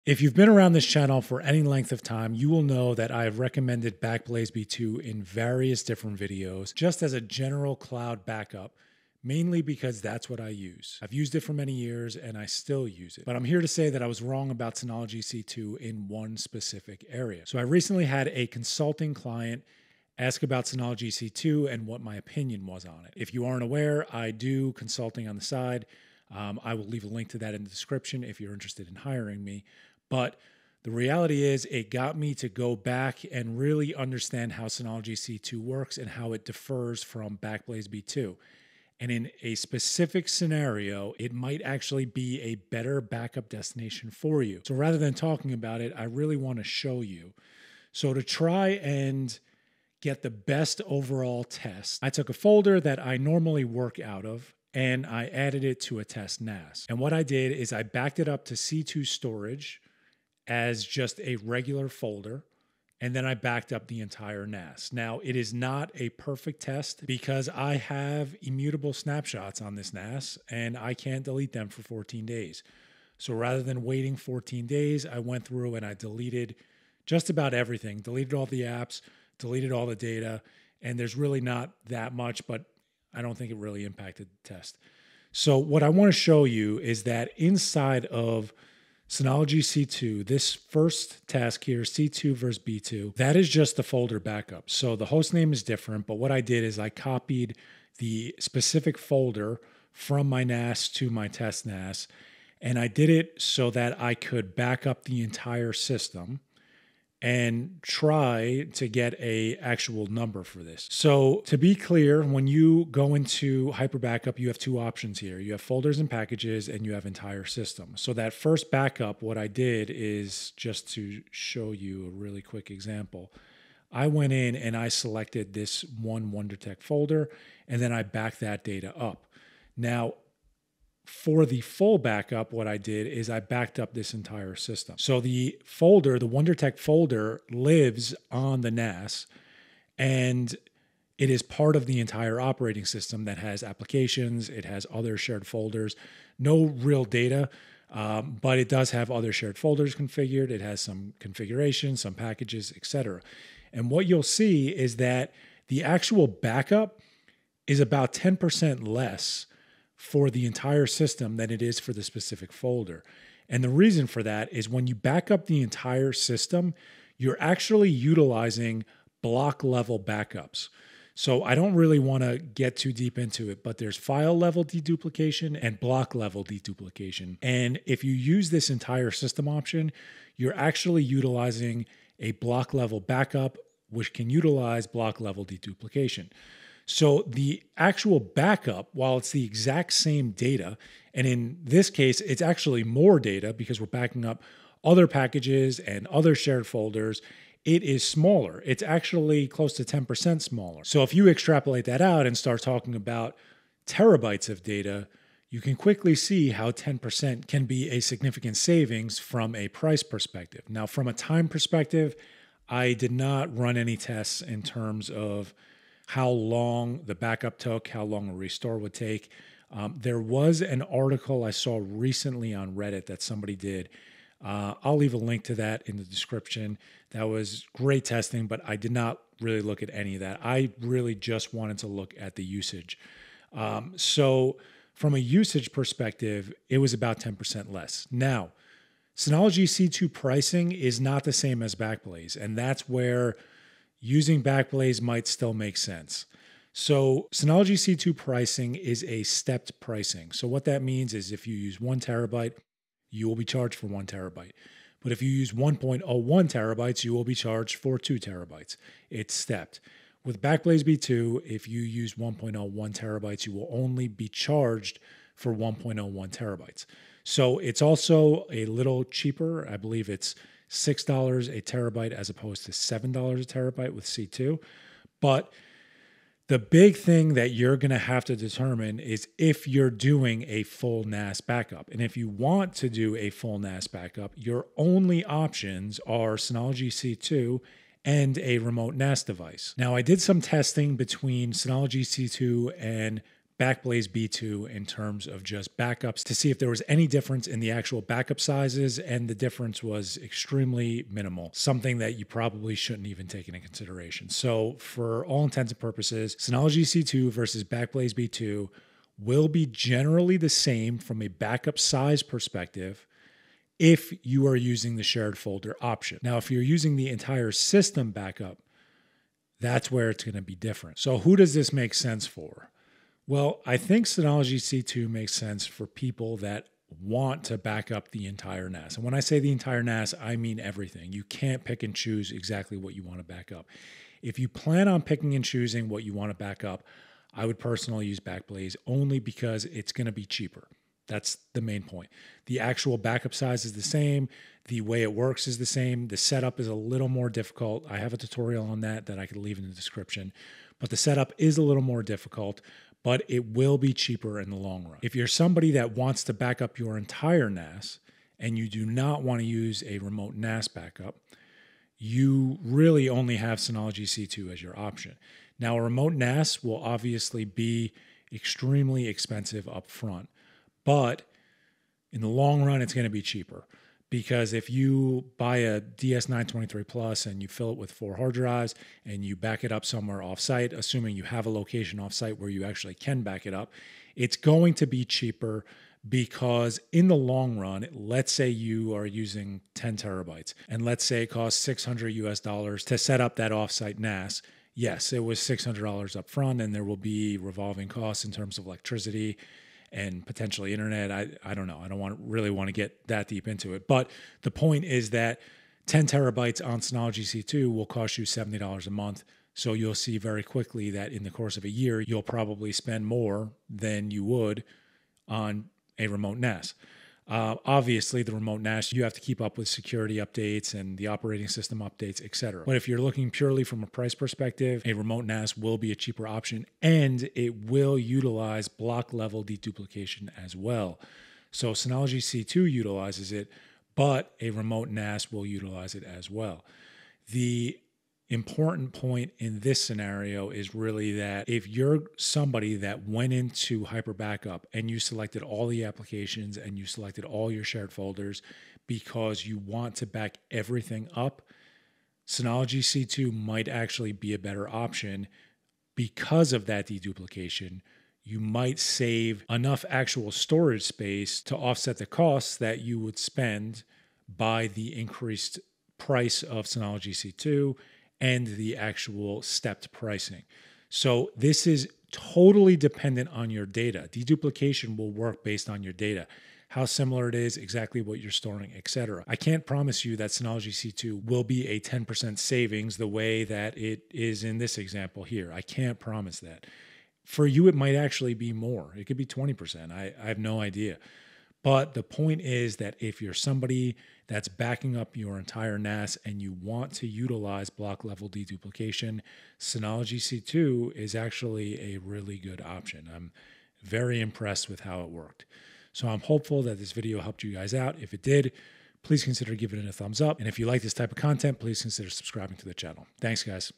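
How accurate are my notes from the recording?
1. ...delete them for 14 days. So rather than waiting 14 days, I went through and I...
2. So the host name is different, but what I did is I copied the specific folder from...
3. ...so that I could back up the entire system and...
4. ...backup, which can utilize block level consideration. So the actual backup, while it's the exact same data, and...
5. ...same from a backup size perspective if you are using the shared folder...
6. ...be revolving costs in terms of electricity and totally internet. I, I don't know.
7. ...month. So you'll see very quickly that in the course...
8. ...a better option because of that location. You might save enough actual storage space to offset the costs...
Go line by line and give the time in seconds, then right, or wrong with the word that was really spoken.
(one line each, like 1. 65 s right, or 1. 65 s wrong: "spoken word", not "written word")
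1. 71 s right
2. 94 s right
3. 103 s right
4. 182 s wrong: "deduplication", not "consideration"
5. 310 s right
6. 396 s wrong: "potentially", not "totally"
7. 408 s right
8. 454 s wrong: "deduplication", not "location".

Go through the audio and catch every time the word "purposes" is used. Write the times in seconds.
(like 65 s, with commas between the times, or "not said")
305 s.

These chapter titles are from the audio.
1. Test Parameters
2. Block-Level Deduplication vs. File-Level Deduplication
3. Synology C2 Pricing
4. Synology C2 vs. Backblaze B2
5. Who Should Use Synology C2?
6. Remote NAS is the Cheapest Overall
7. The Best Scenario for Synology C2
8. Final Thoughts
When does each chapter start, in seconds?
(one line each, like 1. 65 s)
1. 45 s
2. 169 s
3. 240 s
4. 291 s
5. 321 s
6. 365 s
7. 438 s
8. 492 s.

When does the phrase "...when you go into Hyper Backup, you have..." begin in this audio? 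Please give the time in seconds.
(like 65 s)
112 s.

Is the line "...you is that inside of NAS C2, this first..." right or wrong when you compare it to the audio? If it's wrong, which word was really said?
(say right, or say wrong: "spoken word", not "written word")
wrong: "Synology", not "NAS".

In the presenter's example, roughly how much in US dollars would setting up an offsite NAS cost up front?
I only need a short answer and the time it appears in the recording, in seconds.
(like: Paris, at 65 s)
$600, at 391 s.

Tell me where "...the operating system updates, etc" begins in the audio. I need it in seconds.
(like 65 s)
420 s.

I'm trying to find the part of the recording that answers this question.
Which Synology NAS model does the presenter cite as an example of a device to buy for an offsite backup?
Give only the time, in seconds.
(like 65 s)
375 s.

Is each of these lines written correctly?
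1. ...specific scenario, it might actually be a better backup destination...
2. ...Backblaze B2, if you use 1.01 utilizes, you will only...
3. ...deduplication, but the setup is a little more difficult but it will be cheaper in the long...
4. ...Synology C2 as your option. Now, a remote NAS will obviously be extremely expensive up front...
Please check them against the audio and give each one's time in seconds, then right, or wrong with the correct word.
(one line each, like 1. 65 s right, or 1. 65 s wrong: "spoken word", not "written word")
1. 39 s right
2. 260 s wrong: "terabytes", not "utilizes"
3. 349 s wrong: "description", not "deduplication"
4. 363 s right.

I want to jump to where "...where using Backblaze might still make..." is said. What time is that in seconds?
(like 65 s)
242 s.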